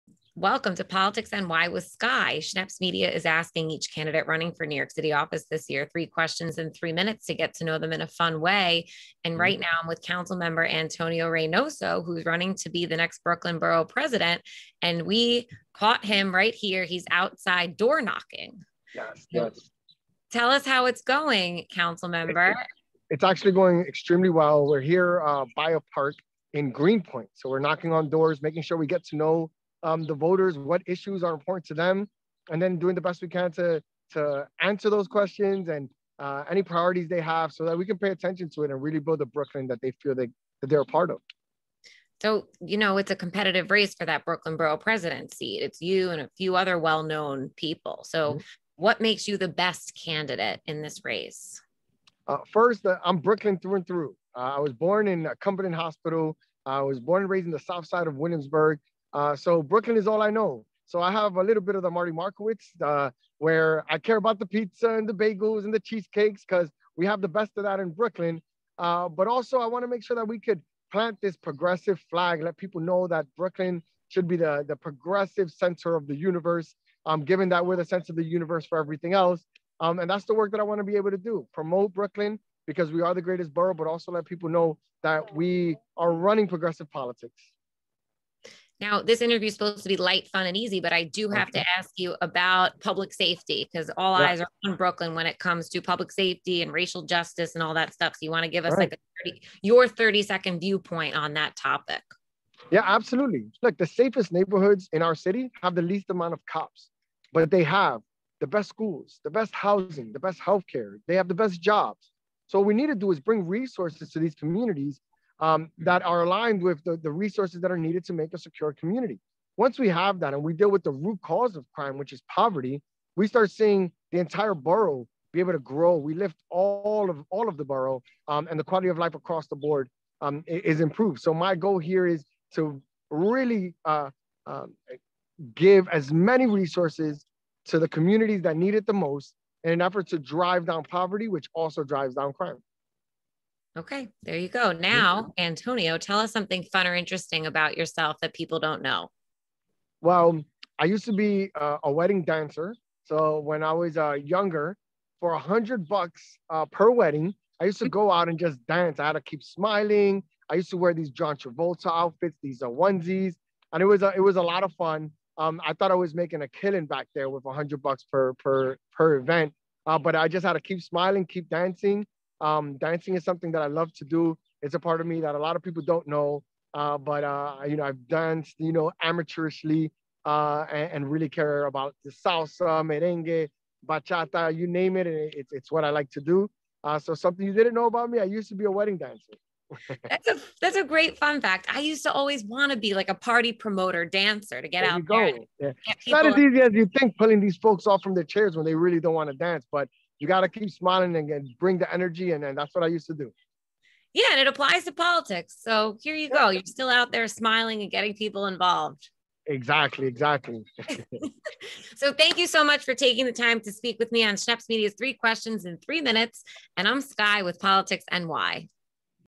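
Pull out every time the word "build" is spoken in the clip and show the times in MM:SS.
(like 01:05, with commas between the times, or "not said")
00:38.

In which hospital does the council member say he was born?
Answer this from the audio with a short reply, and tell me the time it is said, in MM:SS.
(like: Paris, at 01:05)
Cumberland Hospital, at 00:55.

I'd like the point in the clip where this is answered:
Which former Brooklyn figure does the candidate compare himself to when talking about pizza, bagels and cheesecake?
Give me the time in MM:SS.
01:01.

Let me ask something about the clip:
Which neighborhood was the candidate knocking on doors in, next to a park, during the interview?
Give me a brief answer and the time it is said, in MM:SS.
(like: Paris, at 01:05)
Greenpoint, at 00:26.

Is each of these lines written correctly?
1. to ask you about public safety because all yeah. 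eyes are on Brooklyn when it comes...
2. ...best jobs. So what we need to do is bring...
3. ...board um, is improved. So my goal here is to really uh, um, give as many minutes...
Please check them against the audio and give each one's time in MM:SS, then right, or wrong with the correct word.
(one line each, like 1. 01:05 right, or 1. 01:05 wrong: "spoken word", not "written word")
1. 01:31 right
2. 01:51 right
3. 02:09 wrong: "resources", not "minutes".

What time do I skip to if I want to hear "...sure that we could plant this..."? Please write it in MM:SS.
01:10.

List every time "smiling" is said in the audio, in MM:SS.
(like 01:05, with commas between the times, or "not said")
02:39, 02:50, 03:20, 03:27.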